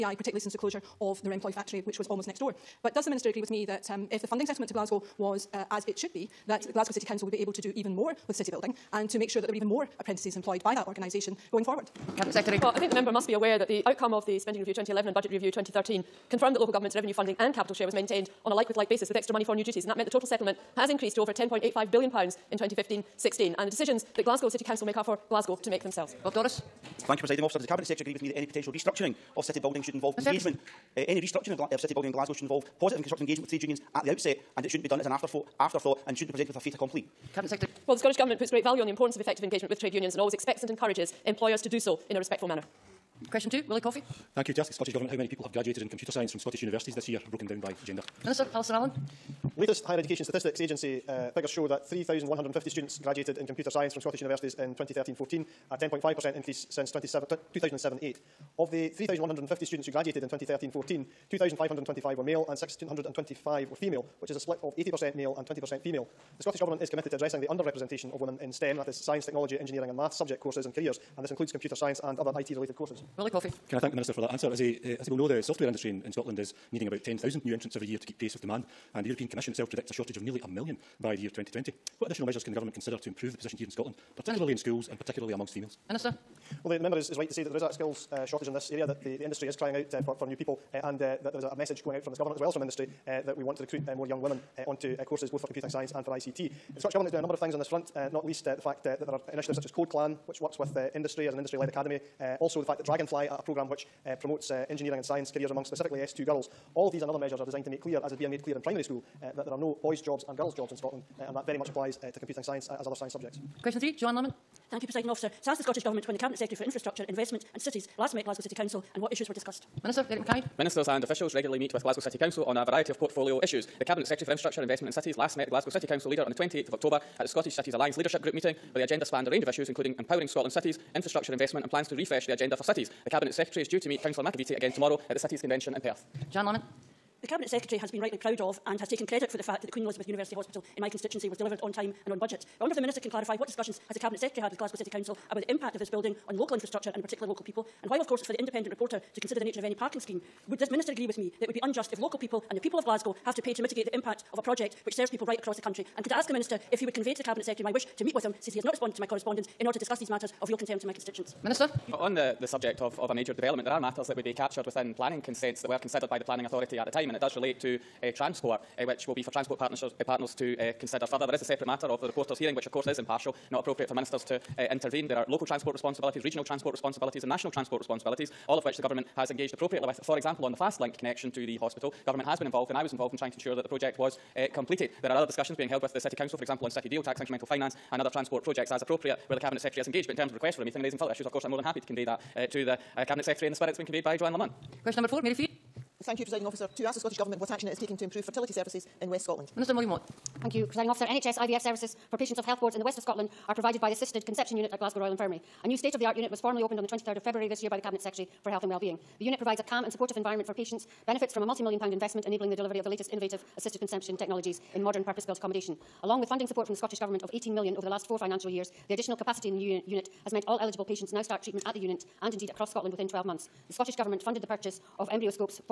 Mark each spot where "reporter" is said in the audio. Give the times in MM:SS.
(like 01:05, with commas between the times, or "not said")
02:28, 02:52.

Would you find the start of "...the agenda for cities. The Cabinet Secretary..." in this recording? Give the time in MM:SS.
02:12.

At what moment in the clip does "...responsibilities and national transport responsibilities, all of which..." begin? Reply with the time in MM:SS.
02:56.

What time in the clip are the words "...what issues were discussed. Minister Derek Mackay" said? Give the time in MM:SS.
01:59.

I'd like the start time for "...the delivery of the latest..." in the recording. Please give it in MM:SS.
03:32.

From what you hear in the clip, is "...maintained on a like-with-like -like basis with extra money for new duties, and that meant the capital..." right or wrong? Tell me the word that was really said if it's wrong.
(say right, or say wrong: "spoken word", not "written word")
wrong: "total", not "capital".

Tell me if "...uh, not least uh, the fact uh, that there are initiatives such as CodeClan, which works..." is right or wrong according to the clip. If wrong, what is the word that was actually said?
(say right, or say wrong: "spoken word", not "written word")
right.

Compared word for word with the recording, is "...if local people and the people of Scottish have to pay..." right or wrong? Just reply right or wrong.
wrong.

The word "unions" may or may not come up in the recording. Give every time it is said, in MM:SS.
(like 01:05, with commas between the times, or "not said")
00:33, 00:39.